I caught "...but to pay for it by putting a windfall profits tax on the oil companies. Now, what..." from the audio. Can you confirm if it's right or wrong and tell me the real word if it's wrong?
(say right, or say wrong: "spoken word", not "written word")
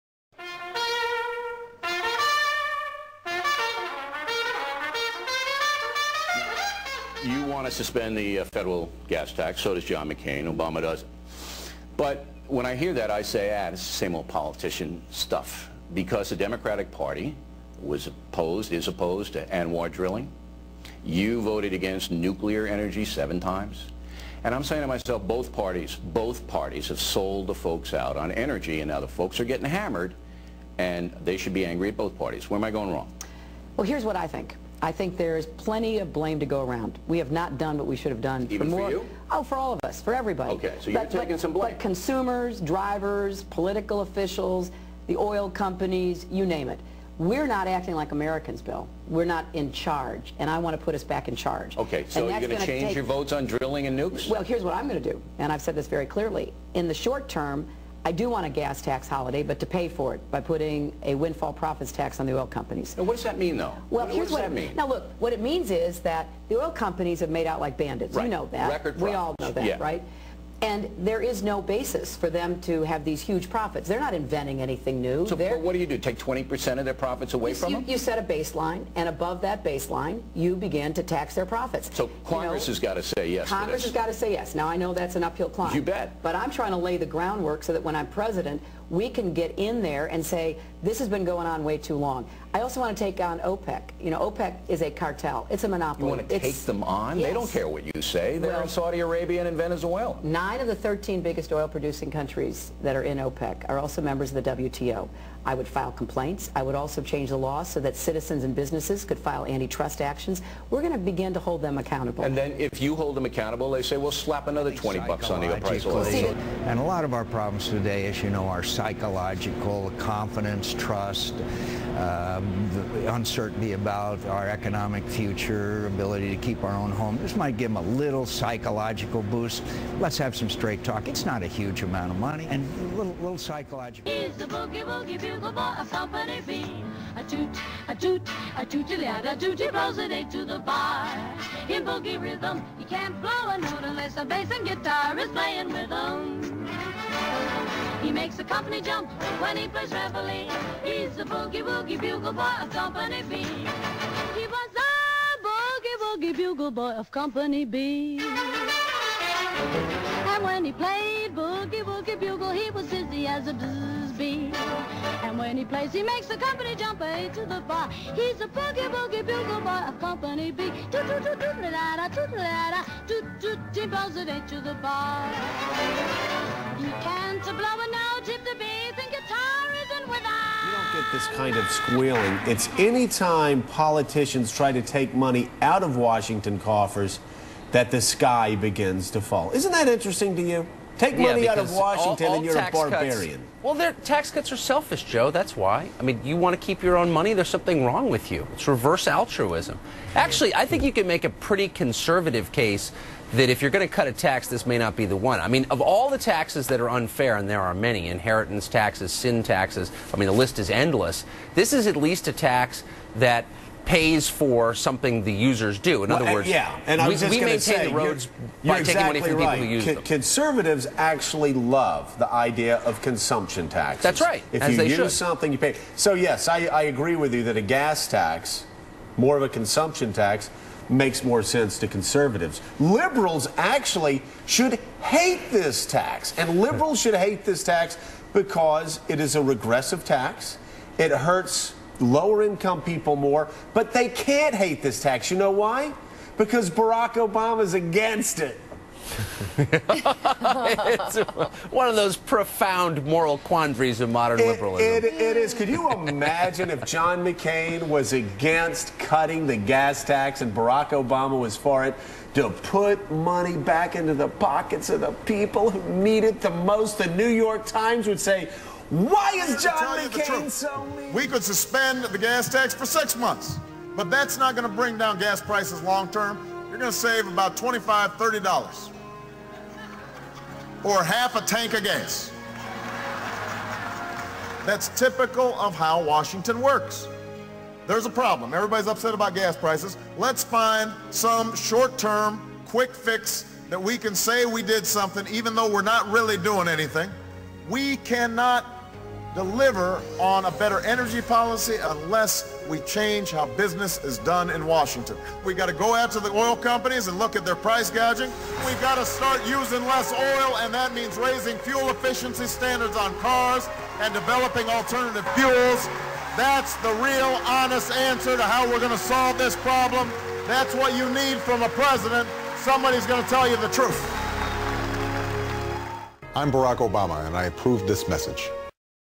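right.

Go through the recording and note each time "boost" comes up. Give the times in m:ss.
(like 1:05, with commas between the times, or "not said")
2:09.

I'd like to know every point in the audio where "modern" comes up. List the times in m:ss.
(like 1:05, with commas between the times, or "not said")
4:14.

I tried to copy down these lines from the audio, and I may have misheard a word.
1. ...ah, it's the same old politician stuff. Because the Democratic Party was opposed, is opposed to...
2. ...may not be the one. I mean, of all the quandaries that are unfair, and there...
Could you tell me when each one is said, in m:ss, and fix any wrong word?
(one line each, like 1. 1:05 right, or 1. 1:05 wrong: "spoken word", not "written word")
1. 0:13 right
2. 3:24 wrong: "taxes", not "quandaries".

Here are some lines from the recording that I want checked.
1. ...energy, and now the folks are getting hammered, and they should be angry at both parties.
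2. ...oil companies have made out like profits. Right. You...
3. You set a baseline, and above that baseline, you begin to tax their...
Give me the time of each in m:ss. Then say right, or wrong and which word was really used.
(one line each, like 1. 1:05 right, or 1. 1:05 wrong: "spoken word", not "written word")
1. 0:28 right
2. 1:06 wrong: "bandits", not "profits"
3. 1:17 right.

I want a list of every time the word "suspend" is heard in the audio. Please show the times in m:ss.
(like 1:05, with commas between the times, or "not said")
0:07, 4:31.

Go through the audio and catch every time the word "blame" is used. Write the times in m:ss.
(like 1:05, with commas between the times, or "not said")
0:36, 0:41.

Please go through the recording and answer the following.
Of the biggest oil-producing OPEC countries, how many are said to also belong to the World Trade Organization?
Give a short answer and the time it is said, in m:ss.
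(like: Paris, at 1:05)
9, at 1:40.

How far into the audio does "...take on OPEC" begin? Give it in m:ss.
1:33.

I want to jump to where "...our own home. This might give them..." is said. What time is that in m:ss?
2:06.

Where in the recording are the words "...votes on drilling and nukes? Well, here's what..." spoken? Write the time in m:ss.
0:53.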